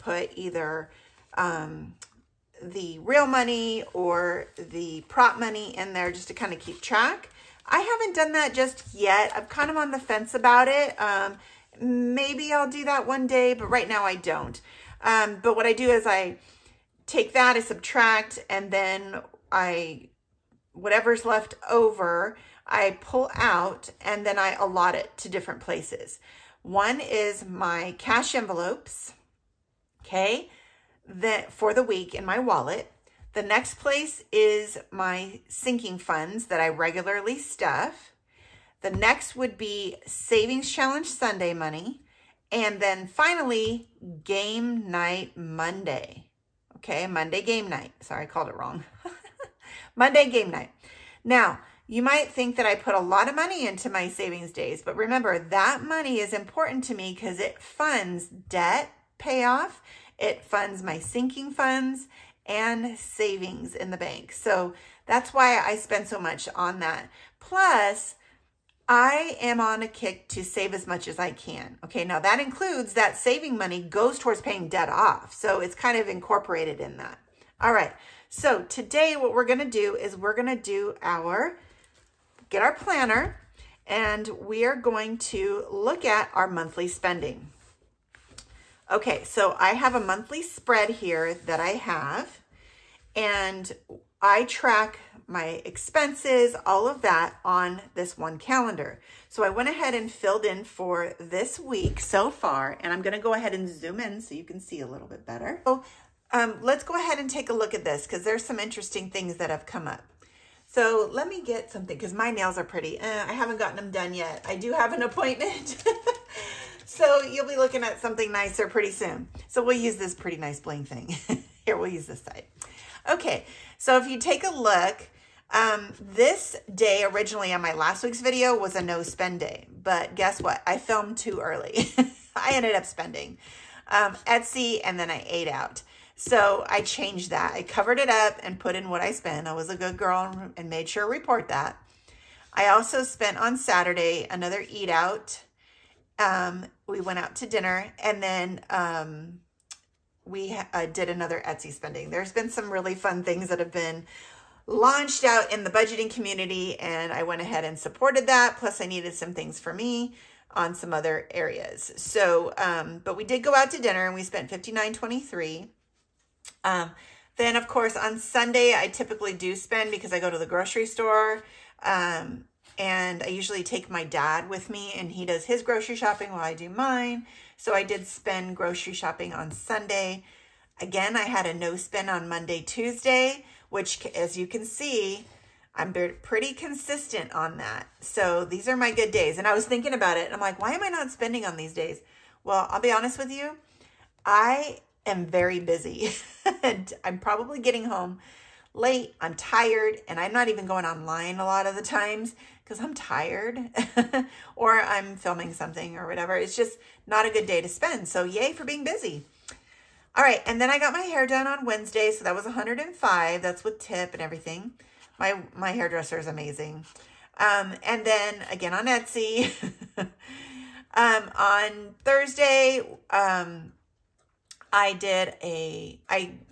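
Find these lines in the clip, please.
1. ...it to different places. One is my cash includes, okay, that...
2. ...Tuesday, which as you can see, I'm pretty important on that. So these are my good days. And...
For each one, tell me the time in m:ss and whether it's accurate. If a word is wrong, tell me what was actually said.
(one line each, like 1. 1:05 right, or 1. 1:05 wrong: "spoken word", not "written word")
1. 0:24 wrong: "envelopes", not "includes"
2. 3:02 wrong: "consistent", not "important".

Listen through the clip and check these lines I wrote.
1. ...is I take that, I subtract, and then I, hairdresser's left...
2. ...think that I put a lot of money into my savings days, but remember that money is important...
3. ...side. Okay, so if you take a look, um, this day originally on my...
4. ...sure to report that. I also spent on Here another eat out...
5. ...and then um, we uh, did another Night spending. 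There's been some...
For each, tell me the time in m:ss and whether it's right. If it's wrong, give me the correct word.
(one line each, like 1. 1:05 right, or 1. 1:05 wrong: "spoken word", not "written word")
1. 0:15 wrong: "whatever", not "hairdresser"
2. 0:52 right
3. 2:02 right
4. 2:20 wrong: "Saturday", not "Here"
5. 2:28 wrong: "Etsy", not "Night".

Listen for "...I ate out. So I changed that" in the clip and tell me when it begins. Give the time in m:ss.
2:15.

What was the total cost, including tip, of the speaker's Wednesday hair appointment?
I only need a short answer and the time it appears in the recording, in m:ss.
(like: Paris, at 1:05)
105, at 3:32.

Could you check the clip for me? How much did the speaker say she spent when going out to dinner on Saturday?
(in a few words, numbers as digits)
$59.23.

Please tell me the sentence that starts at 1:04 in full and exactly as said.
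So that's why I spend so much on that.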